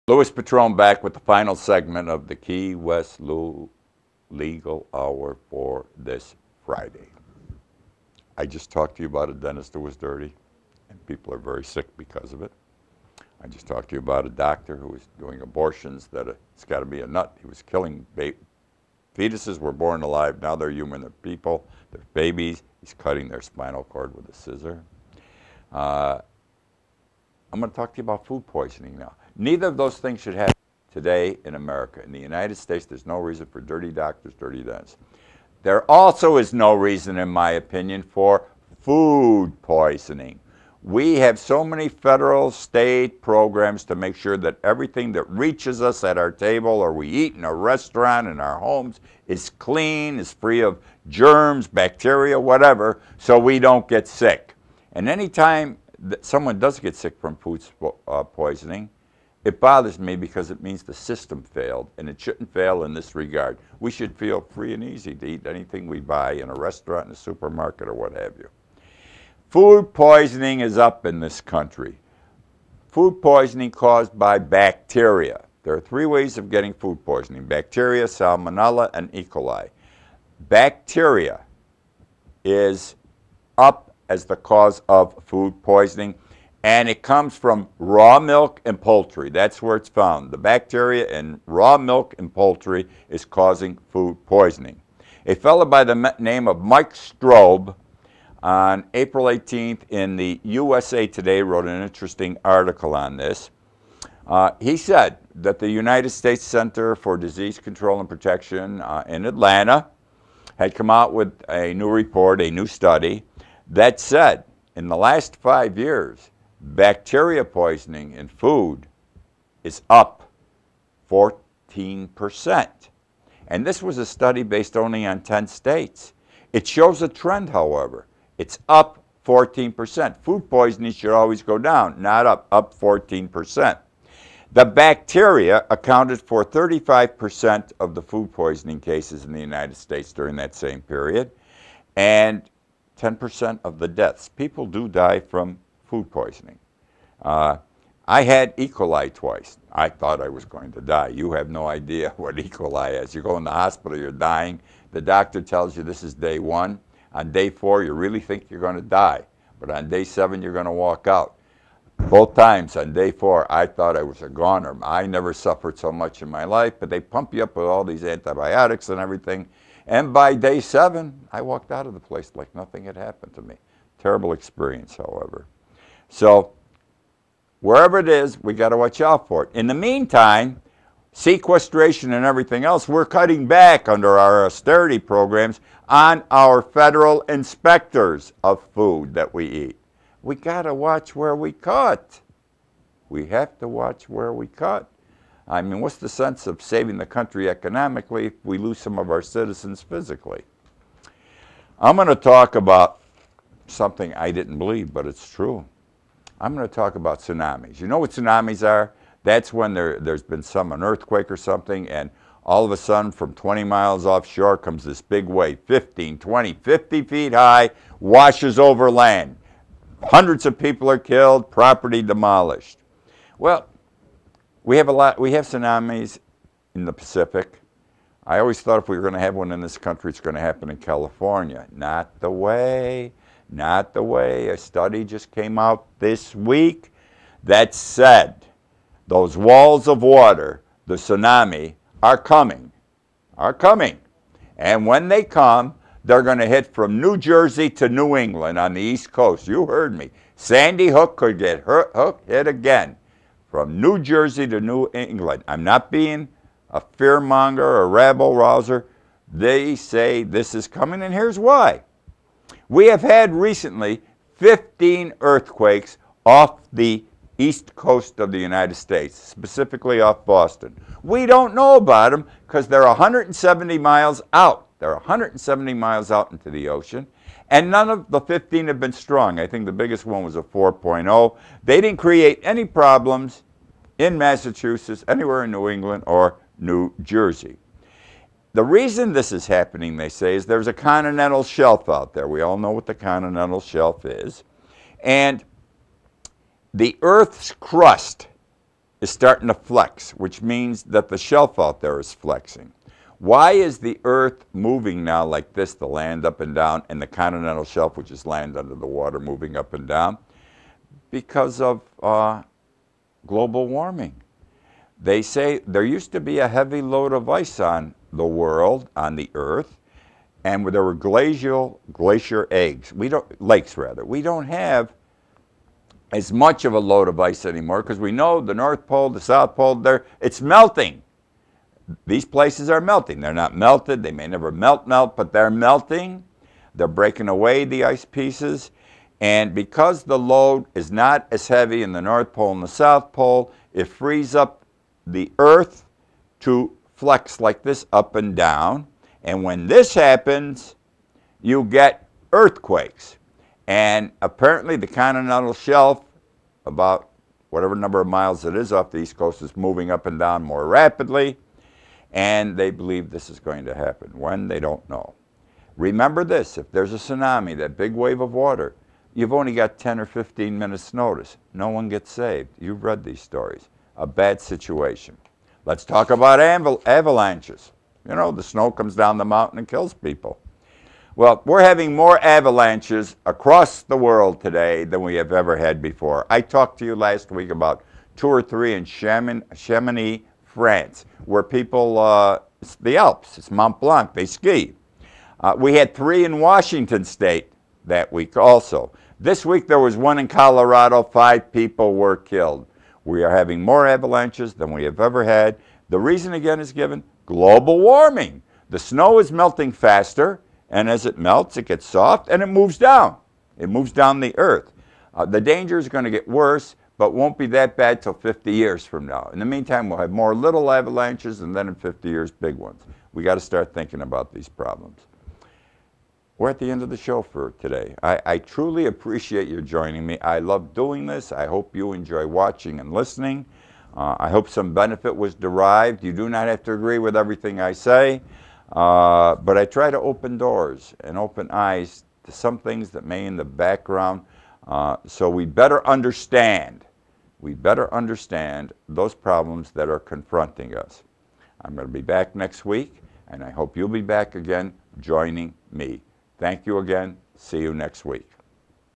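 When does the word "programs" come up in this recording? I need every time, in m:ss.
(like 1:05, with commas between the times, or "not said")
0:43, 3:04.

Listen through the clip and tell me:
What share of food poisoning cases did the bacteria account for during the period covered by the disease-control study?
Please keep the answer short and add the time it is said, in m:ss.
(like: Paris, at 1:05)
35%, at 2:16.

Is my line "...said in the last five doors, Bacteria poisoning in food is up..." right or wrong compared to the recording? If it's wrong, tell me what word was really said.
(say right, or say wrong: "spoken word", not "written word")
wrong: "years", not "doors".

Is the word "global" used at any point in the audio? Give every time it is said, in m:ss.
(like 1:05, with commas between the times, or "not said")
5:13, 6:47.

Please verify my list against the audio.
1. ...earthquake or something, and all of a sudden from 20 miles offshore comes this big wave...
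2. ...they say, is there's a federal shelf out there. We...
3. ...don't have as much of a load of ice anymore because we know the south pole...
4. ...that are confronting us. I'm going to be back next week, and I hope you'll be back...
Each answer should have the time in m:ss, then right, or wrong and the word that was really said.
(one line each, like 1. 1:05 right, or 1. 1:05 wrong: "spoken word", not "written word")
1. 3:30 right
2. 4:49 wrong: "continental", not "federal"
3. 5:24 wrong: "north", not "south"
4. 7:29 right.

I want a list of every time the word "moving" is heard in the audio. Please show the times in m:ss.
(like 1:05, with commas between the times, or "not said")
5:04, 5:09, 5:59.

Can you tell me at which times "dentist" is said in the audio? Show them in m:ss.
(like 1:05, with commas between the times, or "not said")
0:09, 0:34.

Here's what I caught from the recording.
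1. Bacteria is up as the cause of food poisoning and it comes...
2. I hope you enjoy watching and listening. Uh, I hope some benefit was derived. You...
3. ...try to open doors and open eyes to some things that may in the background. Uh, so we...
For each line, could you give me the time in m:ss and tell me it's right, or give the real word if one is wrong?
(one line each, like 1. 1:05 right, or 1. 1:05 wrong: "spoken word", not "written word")
1. 1:20 right
2. 7:11 right
3. 7:19 right.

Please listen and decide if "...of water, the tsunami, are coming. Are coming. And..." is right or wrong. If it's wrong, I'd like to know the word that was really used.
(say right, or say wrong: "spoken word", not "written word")
right.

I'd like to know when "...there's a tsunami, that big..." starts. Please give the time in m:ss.
6:06.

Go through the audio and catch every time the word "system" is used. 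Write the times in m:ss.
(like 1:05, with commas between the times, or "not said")
1:00.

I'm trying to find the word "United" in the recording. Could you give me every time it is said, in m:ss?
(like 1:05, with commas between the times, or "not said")
0:32, 1:45, 2:19, 4:28.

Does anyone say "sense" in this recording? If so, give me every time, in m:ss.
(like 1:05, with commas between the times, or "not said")
3:16.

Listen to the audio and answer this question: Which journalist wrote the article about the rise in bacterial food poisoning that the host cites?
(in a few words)
Mike Stobbe.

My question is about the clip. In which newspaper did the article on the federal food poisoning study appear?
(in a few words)
USA Today.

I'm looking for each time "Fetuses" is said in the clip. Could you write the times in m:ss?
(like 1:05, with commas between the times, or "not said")
0:19.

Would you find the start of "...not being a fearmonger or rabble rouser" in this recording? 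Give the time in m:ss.
4:15.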